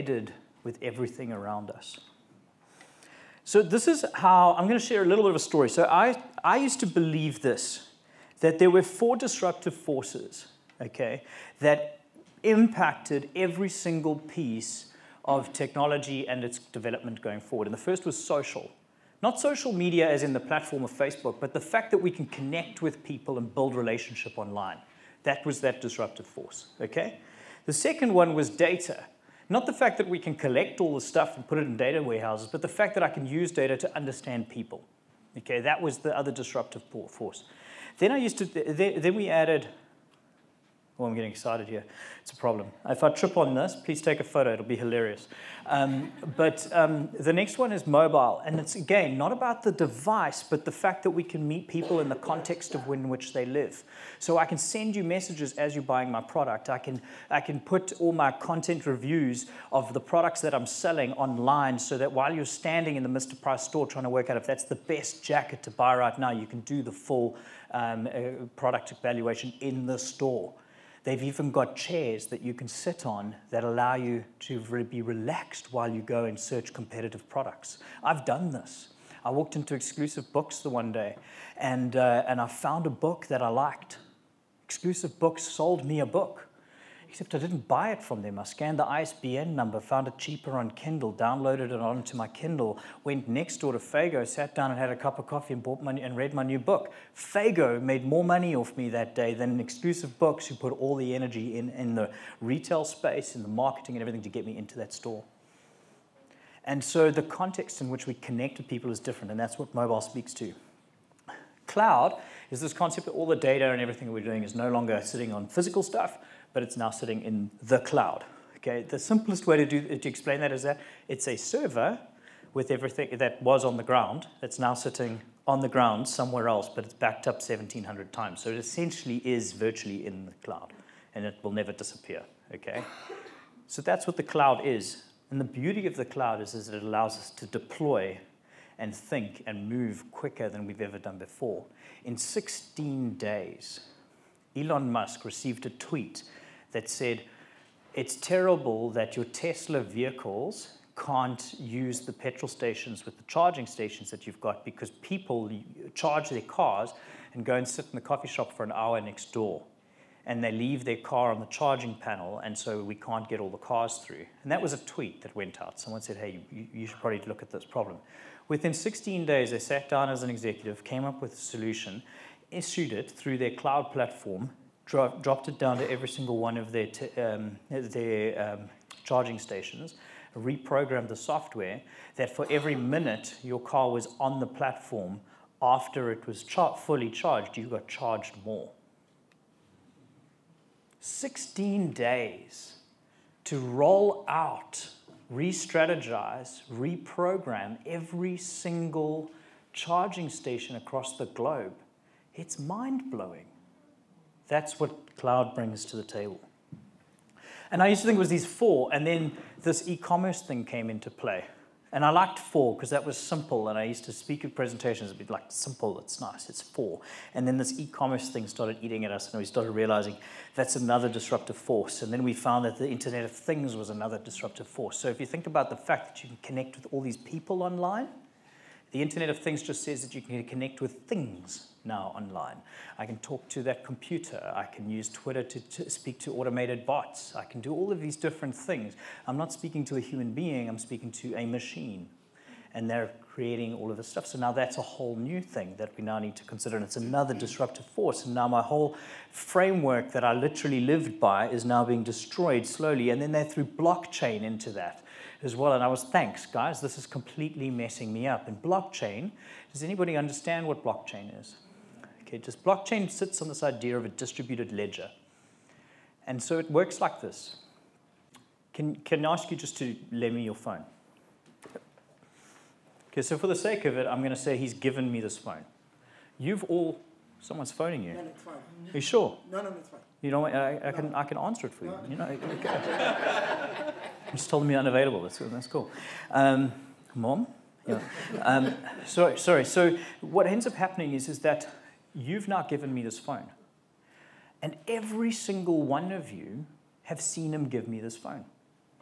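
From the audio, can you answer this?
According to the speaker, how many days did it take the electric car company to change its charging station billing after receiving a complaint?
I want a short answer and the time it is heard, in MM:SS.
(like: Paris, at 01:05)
16, at 02:48.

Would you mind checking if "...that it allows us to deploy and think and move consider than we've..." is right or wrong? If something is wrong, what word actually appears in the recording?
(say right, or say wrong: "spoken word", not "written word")
wrong: "quicker", not "consider".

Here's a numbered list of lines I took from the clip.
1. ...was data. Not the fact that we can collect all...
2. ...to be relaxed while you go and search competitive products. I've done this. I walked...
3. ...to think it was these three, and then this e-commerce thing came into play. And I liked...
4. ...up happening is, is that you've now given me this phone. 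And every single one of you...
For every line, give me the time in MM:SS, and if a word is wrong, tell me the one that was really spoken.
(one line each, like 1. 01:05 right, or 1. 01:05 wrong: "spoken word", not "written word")
1. 00:28 right
2. 01:14 right
3. 03:28 wrong: "four", not "three"
4. 04:50 right.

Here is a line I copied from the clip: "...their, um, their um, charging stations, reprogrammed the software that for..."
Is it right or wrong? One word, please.
right.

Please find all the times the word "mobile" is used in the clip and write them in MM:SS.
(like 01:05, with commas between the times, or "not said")
00:47, 01:49.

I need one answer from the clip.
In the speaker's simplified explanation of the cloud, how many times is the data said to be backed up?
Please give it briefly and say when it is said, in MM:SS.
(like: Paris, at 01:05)
1,700, at 02:07.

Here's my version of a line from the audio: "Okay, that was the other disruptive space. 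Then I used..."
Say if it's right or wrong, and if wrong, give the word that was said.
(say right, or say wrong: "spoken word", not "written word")
wrong: "force", not "space".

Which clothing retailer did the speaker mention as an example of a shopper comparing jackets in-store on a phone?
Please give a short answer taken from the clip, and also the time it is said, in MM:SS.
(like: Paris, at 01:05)
Mr. Price, at 01:03.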